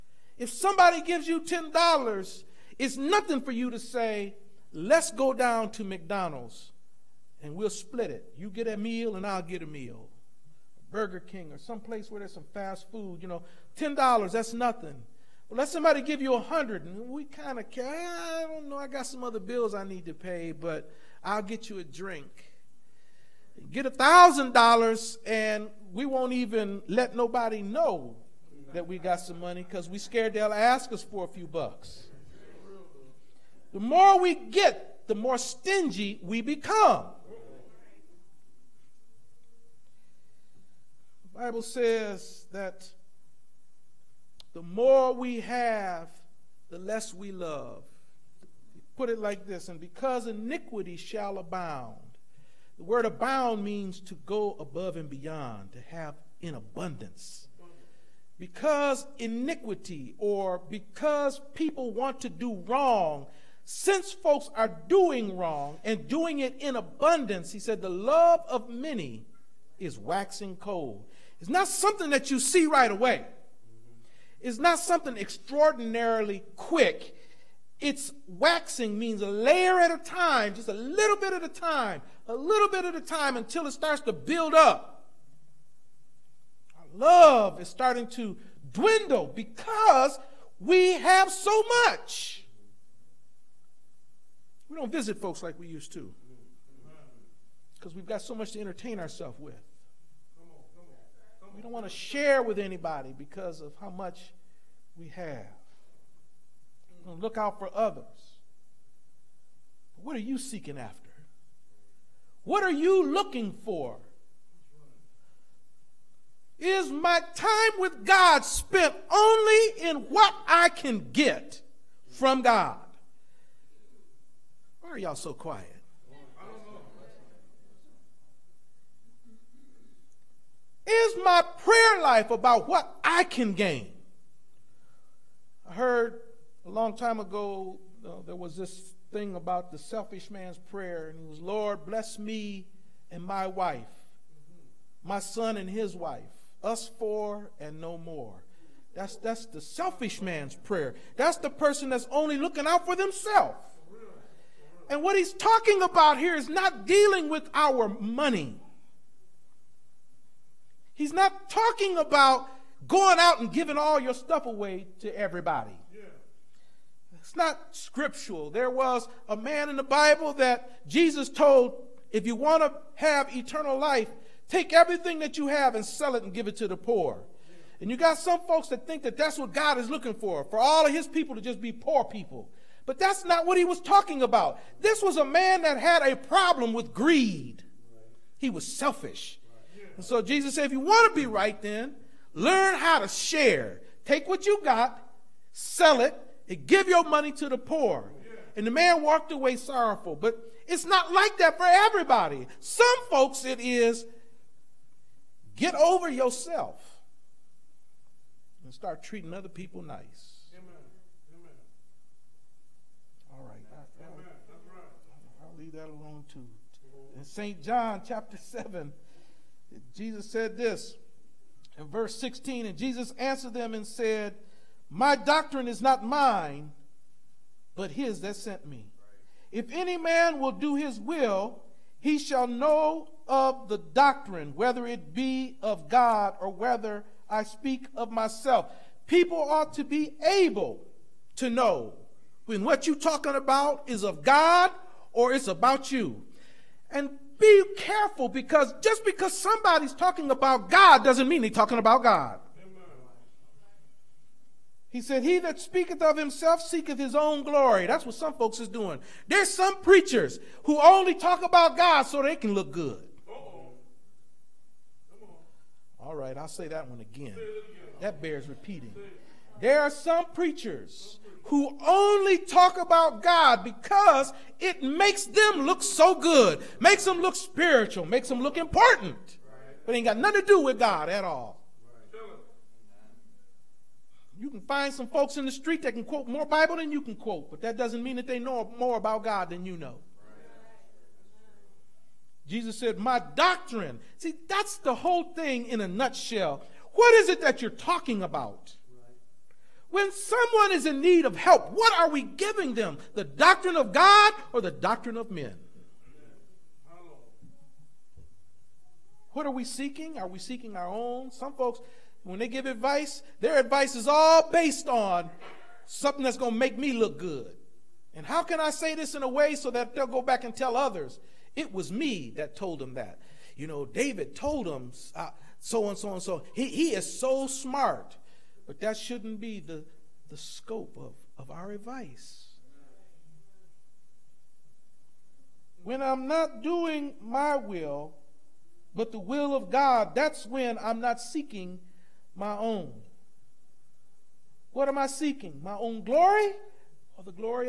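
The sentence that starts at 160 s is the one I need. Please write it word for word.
He's not talking about going out and giving all your stuff away to everybody.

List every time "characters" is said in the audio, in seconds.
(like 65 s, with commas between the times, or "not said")
not said.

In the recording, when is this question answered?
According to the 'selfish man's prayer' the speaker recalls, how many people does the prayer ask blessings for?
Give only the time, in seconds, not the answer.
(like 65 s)
146 s.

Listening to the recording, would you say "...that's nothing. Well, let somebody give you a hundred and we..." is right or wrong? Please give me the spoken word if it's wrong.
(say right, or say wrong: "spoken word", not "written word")
right.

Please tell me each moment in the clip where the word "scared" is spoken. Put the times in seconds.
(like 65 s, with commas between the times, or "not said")
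29 s.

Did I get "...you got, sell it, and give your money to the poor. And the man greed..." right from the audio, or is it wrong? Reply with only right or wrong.
wrong.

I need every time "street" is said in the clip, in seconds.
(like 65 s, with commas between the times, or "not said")
285 s.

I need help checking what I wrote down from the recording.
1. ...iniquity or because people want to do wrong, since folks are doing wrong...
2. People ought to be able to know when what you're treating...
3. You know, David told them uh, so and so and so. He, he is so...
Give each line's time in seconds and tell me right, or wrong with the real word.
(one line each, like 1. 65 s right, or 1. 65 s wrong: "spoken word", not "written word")
1. 59 s right
2. 239 s wrong: "talking", not "treating"
3. 323 s right.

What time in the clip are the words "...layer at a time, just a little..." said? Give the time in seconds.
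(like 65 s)
79 s.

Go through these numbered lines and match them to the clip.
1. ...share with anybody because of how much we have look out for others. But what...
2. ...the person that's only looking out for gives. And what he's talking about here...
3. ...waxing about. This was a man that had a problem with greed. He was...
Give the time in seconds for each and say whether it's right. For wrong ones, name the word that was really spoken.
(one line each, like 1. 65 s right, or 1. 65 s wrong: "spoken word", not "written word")
1. 101 s right
2. 151 s wrong: "themselves", not "gives"
3. 183 s wrong: "talking", not "waxing".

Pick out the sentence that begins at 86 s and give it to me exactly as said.
Our love is starting to dwindle because we have so much.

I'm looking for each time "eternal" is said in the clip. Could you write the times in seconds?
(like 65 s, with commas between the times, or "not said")
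173 s.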